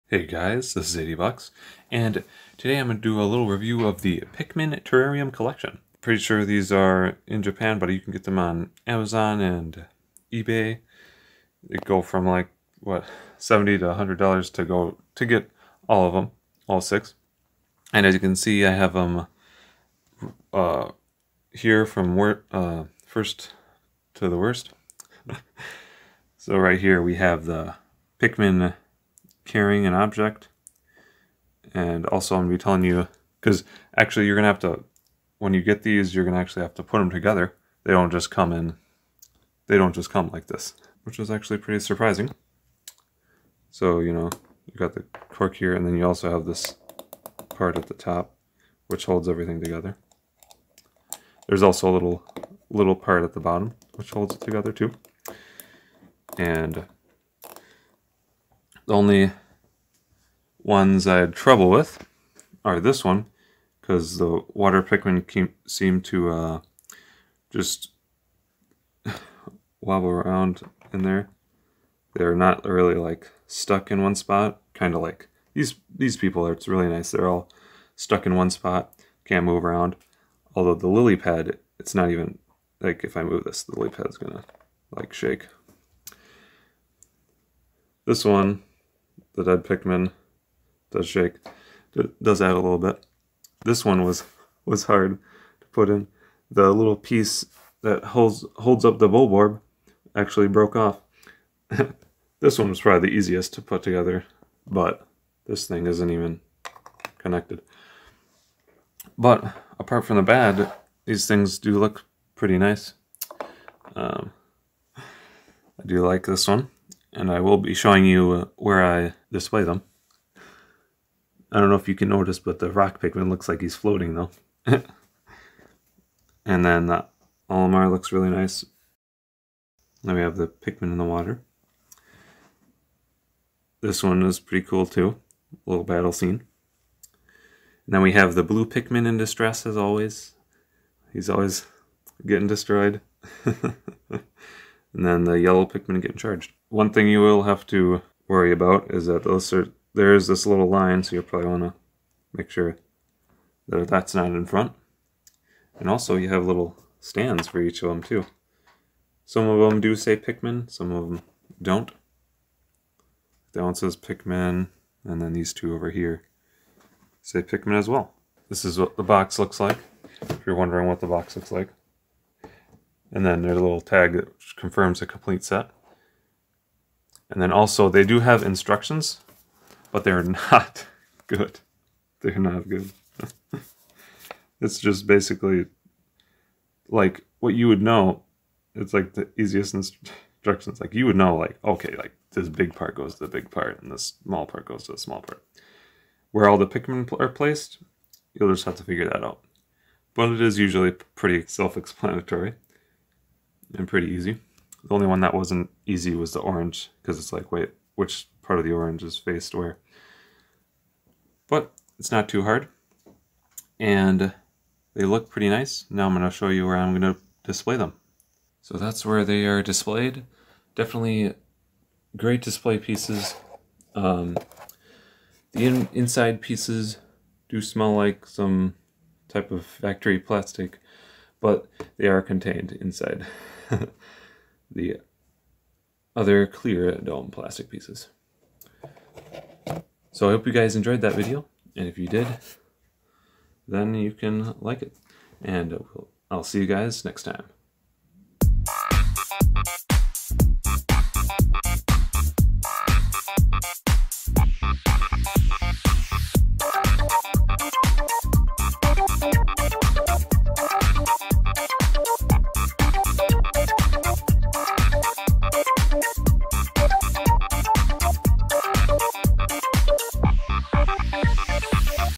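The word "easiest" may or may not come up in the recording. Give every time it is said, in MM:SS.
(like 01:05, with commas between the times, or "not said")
01:43, 03:09.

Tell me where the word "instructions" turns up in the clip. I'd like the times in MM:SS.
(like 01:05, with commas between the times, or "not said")
02:58, 03:09.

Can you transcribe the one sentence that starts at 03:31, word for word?
But it's not too hard, and they look pretty nice.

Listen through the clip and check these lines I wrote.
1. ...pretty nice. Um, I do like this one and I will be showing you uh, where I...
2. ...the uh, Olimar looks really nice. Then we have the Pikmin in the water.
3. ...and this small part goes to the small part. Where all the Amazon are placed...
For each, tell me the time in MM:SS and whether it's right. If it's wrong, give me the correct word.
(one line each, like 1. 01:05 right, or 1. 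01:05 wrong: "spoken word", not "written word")
1. 01:52 right
2. 02:06 right
3. 03:13 wrong: "Pikmin", not "Amazon".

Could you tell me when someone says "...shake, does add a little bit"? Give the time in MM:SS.
01:31.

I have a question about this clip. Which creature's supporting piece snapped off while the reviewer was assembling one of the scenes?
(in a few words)
Bulborb.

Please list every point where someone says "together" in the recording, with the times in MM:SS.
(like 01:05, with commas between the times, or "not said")
00:37, 00:49, 00:54, 01:43.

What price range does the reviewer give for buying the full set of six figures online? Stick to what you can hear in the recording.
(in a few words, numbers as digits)
$70 to $100.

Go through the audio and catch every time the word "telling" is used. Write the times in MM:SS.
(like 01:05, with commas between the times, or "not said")
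00:32.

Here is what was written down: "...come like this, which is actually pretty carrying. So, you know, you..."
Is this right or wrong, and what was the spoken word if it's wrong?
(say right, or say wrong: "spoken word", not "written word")
wrong: "surprising", not "carrying".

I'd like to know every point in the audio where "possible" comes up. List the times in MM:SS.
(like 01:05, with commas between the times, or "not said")
not said.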